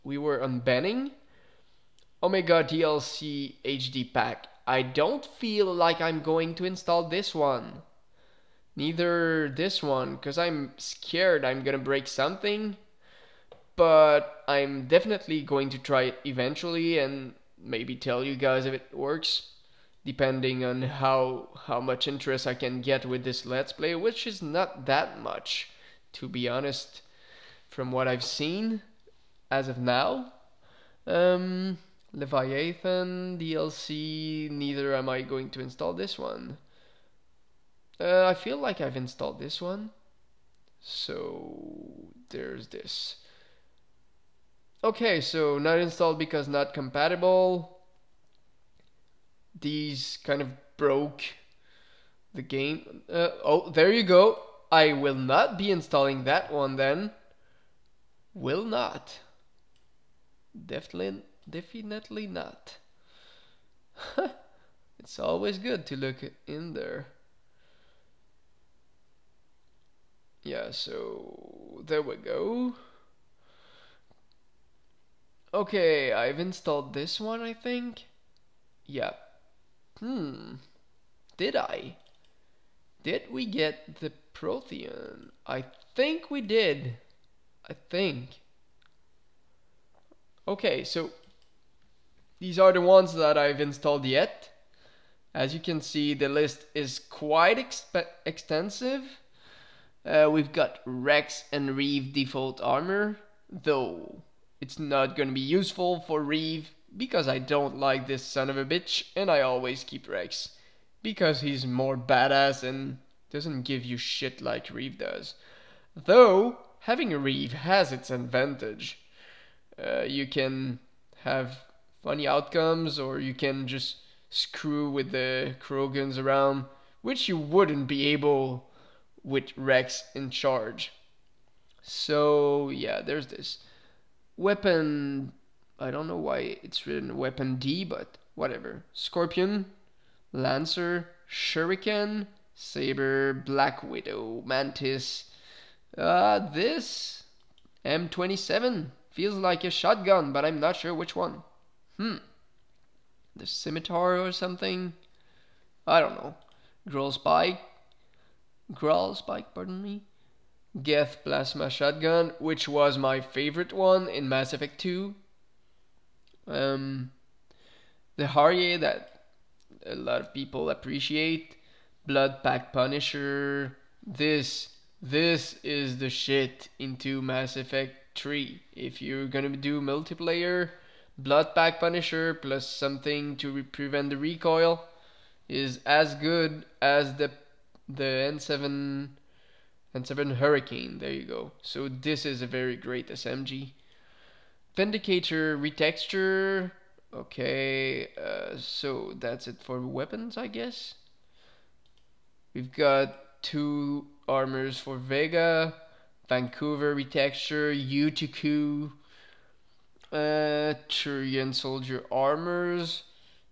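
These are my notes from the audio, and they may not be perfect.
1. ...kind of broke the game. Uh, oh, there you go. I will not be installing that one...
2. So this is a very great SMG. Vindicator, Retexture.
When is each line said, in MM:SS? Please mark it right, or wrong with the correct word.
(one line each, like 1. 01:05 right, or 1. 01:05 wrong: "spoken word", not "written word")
1. 00:50 right
2. 03:11 right.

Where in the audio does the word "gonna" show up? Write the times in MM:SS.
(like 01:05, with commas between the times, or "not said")
00:11, 02:59.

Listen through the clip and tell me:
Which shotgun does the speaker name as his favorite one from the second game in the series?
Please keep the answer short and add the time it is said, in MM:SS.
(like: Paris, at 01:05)
Geth Plasma Shotgun, at 02:40.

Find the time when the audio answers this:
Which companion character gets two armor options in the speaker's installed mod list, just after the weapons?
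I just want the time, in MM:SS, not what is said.
03:24.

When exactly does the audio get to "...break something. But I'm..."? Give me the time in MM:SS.
00:11.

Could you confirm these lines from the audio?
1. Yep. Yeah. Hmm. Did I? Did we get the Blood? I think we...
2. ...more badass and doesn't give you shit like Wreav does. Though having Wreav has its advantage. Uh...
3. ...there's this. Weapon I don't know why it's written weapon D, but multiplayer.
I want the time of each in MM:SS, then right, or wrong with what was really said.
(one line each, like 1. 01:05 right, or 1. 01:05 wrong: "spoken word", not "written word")
1. 01:18 wrong: "Prothean", not "Blood"
2. 01:51 right
3. 02:13 wrong: "whatever", not "multiplayer".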